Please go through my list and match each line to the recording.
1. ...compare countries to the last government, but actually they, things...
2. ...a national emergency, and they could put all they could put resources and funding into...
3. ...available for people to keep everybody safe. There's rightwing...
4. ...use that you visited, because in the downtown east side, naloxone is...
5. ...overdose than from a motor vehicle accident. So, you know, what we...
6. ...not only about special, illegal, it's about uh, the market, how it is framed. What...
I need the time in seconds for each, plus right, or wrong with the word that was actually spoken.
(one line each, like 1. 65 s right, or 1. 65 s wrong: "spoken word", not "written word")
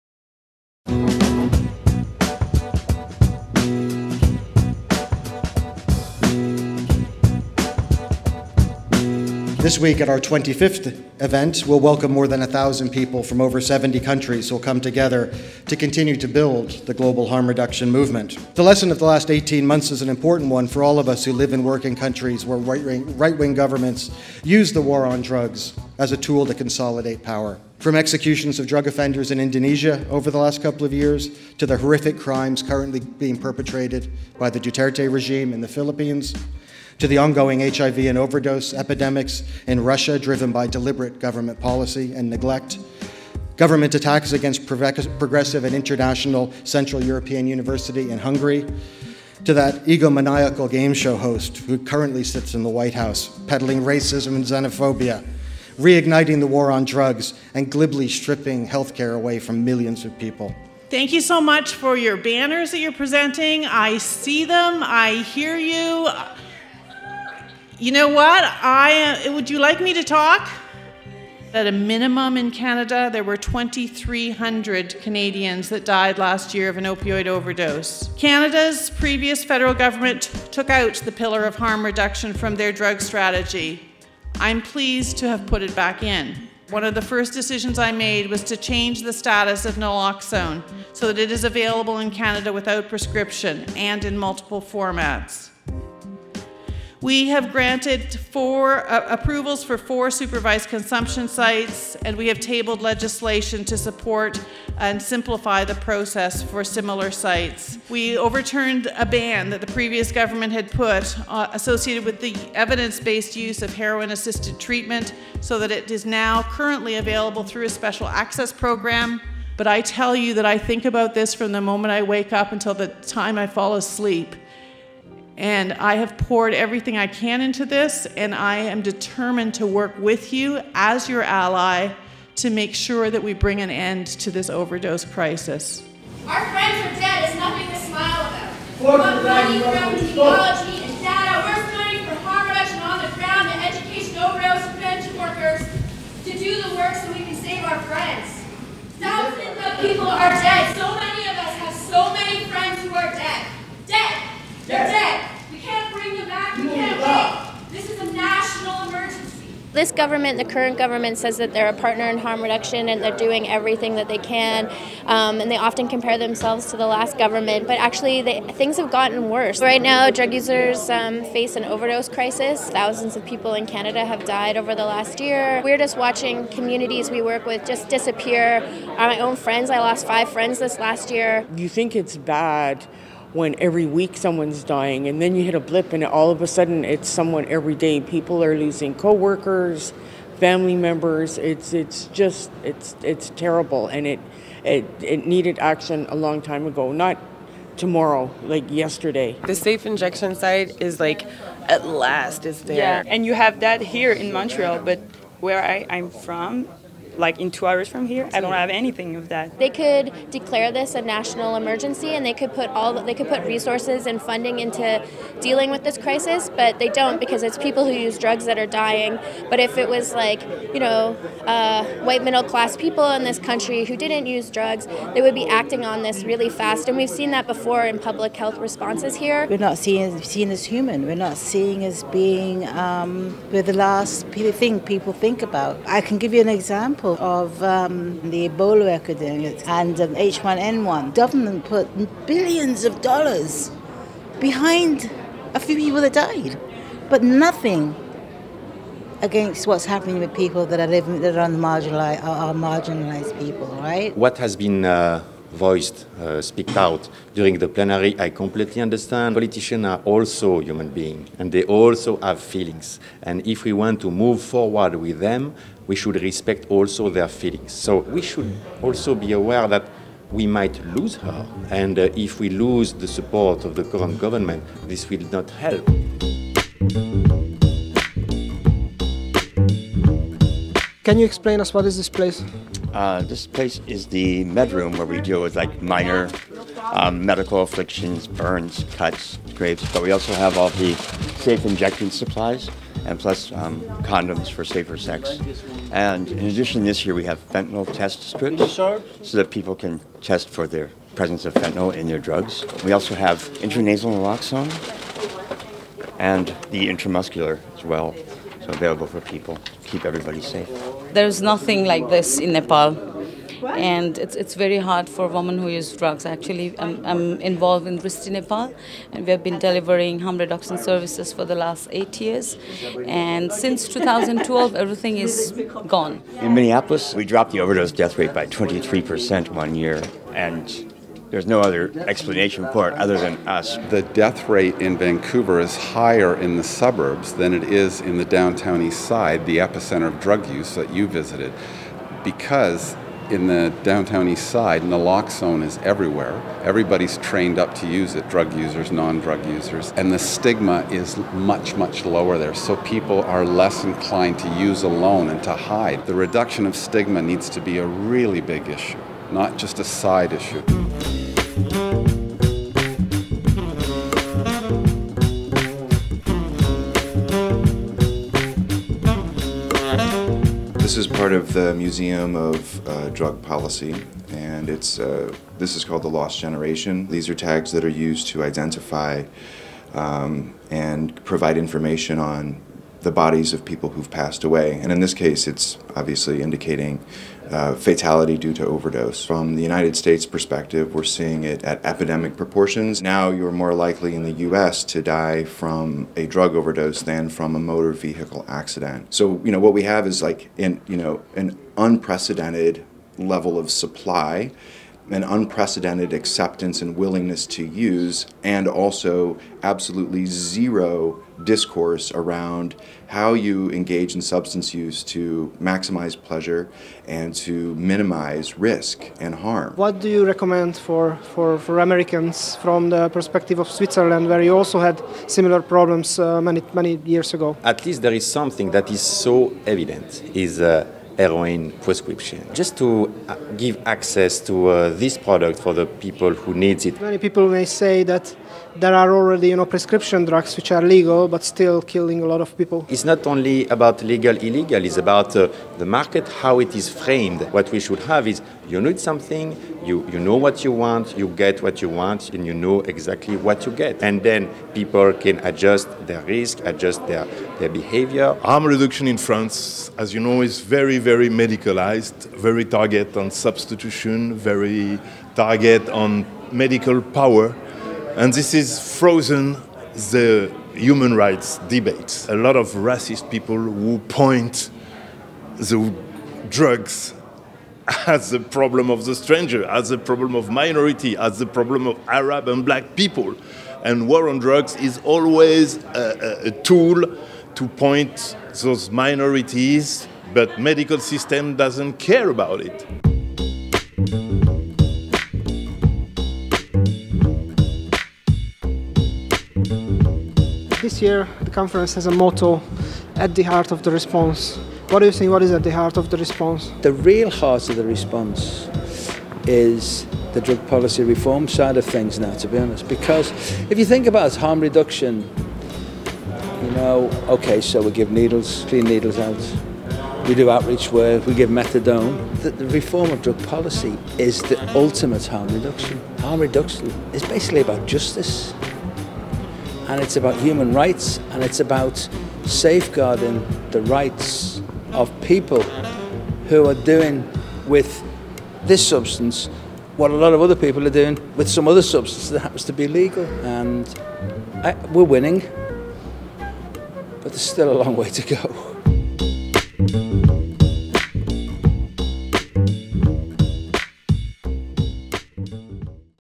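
1. 165 s wrong: "themselves", not "countries"
2. 210 s right
3. 308 s wrong: "nothing", not "rightwing"
4. 340 s right
5. 396 s right
6. 443 s wrong: "legal", not "special".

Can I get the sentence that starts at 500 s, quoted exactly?
This year, the conference has a motto, at the heart of the response.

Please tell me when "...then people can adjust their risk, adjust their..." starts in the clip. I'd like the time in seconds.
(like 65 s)
454 s.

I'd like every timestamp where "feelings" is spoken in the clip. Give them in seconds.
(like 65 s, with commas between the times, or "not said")
262 s, 267 s.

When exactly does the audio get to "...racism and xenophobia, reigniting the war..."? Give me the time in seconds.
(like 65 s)
53 s.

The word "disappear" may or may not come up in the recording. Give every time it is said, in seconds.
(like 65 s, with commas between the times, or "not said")
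177 s.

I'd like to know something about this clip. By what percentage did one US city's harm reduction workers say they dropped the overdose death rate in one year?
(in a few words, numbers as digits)
23%.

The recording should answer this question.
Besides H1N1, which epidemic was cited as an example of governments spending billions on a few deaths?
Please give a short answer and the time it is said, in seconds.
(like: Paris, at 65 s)
Ebola, at 238 s.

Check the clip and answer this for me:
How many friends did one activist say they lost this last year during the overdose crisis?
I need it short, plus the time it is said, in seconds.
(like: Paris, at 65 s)
5, at 180 s.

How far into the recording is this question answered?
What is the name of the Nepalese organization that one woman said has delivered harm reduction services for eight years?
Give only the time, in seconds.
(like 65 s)
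317 s.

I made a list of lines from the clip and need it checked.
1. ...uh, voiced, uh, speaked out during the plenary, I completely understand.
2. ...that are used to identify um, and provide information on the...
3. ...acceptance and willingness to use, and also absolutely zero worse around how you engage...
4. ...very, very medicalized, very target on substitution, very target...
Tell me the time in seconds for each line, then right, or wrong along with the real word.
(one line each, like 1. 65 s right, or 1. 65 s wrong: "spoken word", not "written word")
1. 254 s right
2. 377 s right
3. 406 s wrong: "discourse", not "worse"
4. 460 s right.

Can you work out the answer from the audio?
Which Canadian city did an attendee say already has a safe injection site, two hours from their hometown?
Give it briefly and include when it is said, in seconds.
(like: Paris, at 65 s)
Montreal, at 204 s.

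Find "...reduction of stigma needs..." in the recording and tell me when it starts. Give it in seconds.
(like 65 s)
356 s.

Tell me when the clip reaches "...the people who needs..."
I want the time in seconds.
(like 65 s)
435 s.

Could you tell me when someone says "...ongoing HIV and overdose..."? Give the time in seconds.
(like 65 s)
37 s.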